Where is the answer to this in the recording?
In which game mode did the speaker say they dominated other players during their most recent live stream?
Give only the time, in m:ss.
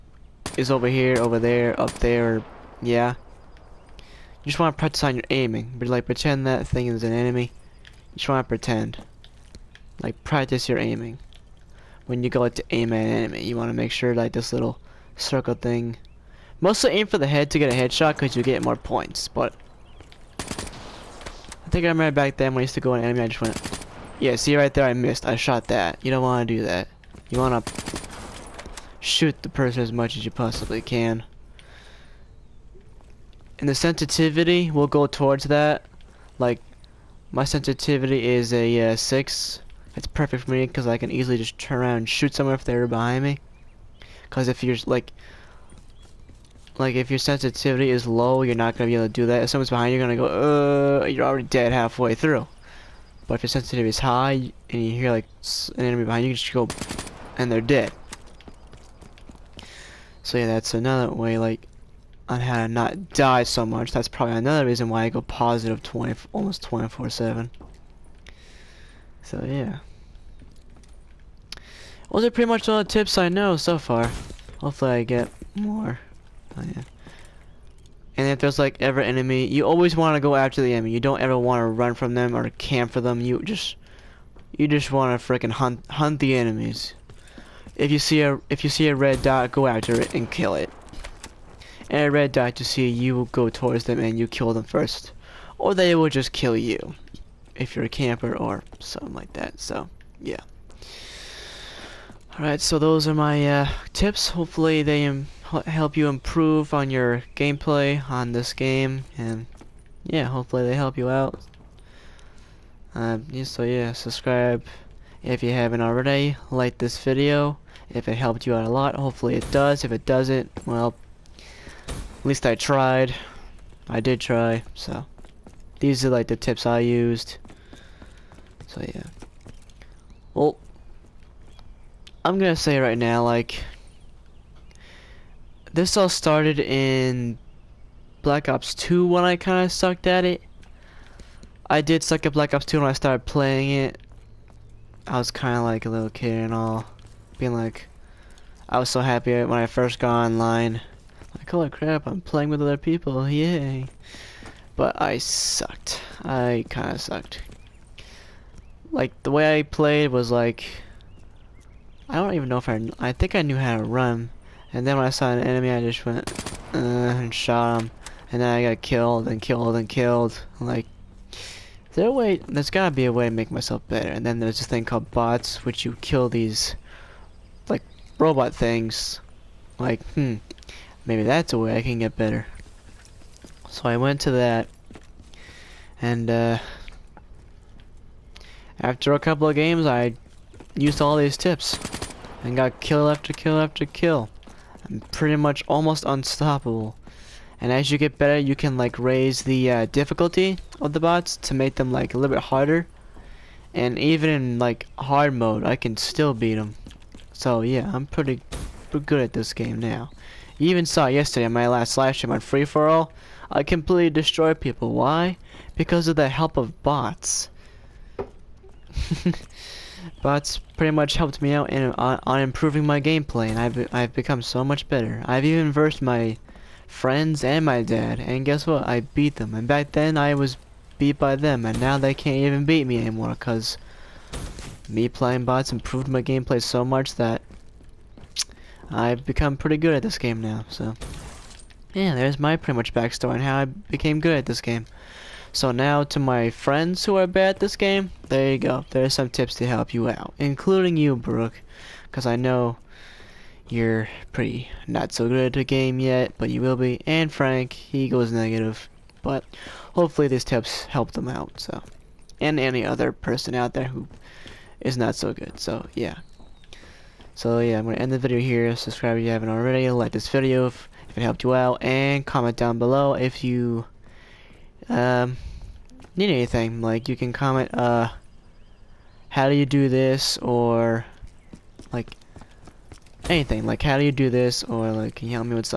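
3:32.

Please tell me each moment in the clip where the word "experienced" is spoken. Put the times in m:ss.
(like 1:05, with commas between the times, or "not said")
not said.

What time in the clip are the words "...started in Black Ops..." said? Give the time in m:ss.
2:16.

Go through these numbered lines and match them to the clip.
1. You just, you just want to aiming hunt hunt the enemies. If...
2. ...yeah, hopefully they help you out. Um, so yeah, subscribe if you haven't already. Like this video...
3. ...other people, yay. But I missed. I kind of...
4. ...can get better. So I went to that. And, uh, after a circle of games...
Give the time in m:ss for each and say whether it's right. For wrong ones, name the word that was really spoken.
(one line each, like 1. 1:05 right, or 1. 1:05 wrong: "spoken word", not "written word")
1. 1:23 wrong: "fricking", not "aiming"
2. 1:50 right
3. 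2:32 wrong: "sucked", not "missed"
4. 3:01 wrong: "couple", not "circle".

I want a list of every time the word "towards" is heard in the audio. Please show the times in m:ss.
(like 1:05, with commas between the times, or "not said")
0:35, 1:33.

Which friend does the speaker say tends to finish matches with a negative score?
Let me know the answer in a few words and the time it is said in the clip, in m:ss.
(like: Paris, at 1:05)
Frank, at 4:17.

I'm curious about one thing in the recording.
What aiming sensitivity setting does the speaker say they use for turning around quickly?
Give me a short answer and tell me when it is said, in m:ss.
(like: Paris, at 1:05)
6, at 0:38.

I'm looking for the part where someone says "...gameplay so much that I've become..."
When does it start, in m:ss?
3:56.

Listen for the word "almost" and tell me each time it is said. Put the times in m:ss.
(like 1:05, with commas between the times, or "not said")
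1:06, 3:15.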